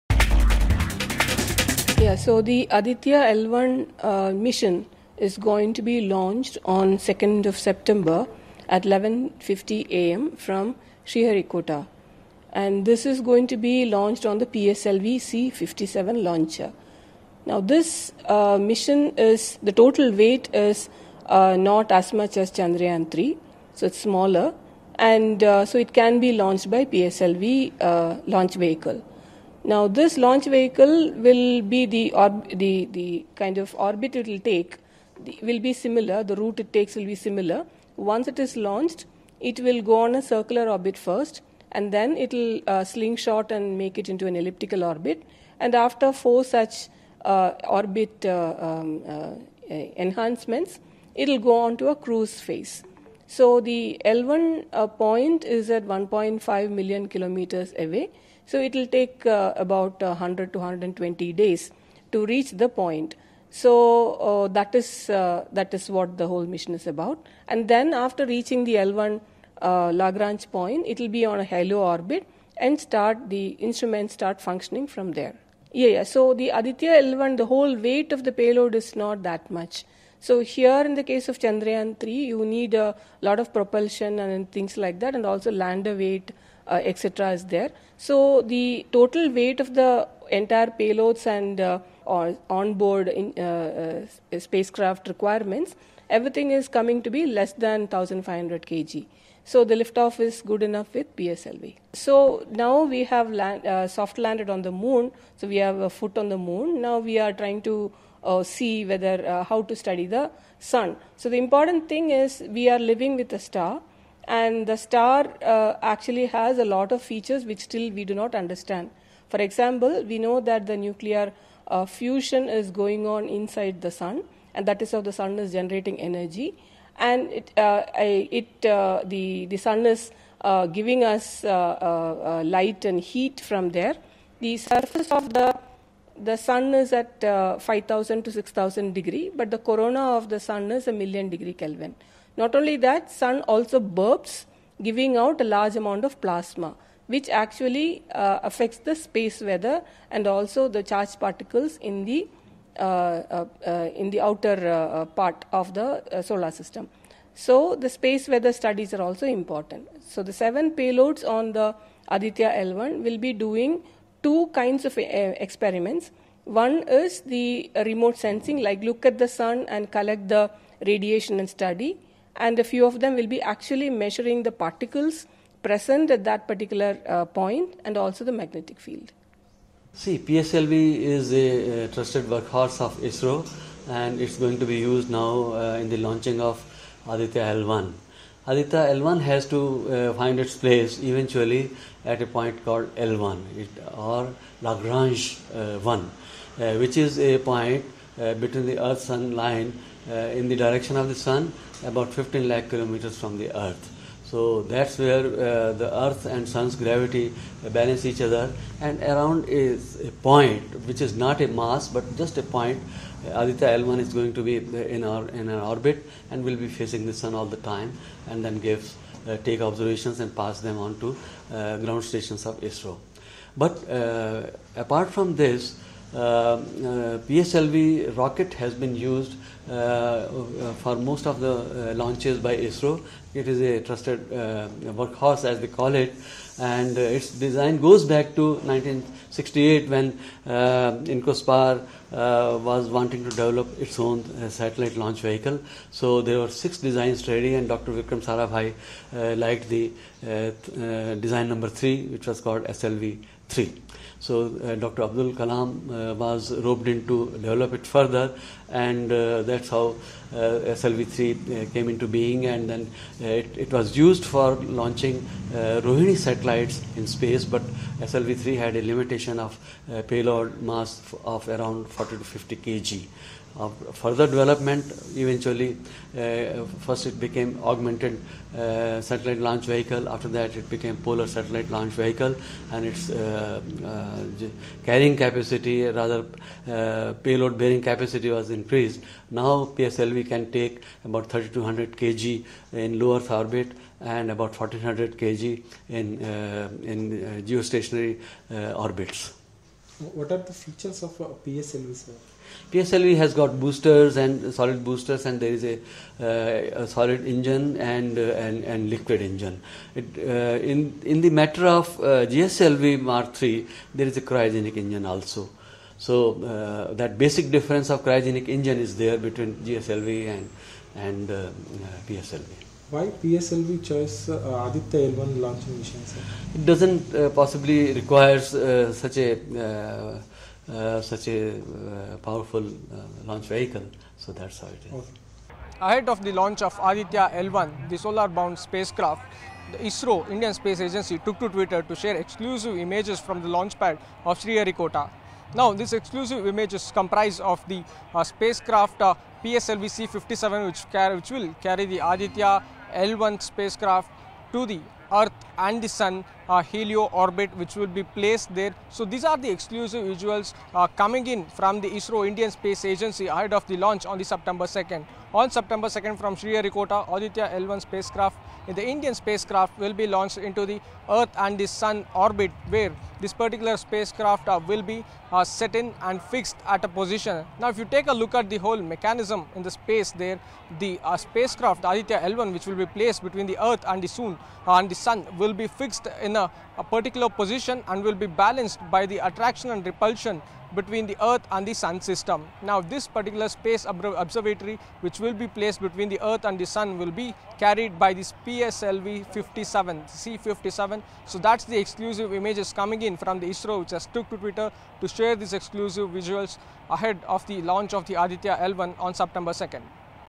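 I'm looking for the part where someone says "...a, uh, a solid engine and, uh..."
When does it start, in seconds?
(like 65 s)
305 s.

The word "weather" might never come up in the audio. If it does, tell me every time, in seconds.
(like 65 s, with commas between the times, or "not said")
149 s, 158 s.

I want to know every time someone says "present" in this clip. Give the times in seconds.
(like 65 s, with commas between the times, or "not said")
175 s.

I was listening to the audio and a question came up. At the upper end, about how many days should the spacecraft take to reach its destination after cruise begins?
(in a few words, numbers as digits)
120.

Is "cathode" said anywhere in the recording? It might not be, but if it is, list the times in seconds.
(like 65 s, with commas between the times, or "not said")
not said.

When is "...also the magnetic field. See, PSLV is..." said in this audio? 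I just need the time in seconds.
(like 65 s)
177 s.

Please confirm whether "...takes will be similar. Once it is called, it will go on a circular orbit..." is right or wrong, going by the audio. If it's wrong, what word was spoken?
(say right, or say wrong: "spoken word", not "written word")
wrong: "launched", not "called".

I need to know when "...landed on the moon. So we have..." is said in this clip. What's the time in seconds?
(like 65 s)
104 s.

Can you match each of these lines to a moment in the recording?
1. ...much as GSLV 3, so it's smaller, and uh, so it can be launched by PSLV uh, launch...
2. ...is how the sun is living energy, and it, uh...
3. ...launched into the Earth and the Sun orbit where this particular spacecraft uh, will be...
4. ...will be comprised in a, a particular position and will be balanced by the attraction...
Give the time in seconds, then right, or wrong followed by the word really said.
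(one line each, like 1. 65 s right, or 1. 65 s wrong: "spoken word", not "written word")
1. 22 s wrong: "Chandrayaan", not "GSLV"
2. 124 s wrong: "generating", not "living"
3. 370 s right
4. 385 s wrong: "fixed", not "comprised".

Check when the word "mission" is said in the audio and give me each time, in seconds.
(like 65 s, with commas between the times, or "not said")
4 s, 18 s, 66 s, 325 s.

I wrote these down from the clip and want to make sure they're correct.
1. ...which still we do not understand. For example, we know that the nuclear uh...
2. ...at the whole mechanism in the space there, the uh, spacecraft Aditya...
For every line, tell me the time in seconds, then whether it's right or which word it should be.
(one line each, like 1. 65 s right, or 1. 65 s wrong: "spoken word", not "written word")
1. 117 s right
2. 378 s right.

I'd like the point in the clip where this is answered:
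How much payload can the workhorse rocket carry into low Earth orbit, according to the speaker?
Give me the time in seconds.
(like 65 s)
291 s.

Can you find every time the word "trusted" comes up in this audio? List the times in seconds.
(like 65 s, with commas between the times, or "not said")
181 s, 233 s.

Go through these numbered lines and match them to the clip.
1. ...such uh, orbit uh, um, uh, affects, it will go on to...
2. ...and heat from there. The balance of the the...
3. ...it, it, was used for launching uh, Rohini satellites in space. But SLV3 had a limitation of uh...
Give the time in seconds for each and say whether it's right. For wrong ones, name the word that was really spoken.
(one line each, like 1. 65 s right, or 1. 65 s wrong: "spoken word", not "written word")
1. 46 s wrong: "enhancements", not "affects"
2. 132 s wrong: "surface", not "balance"
3. 263 s right.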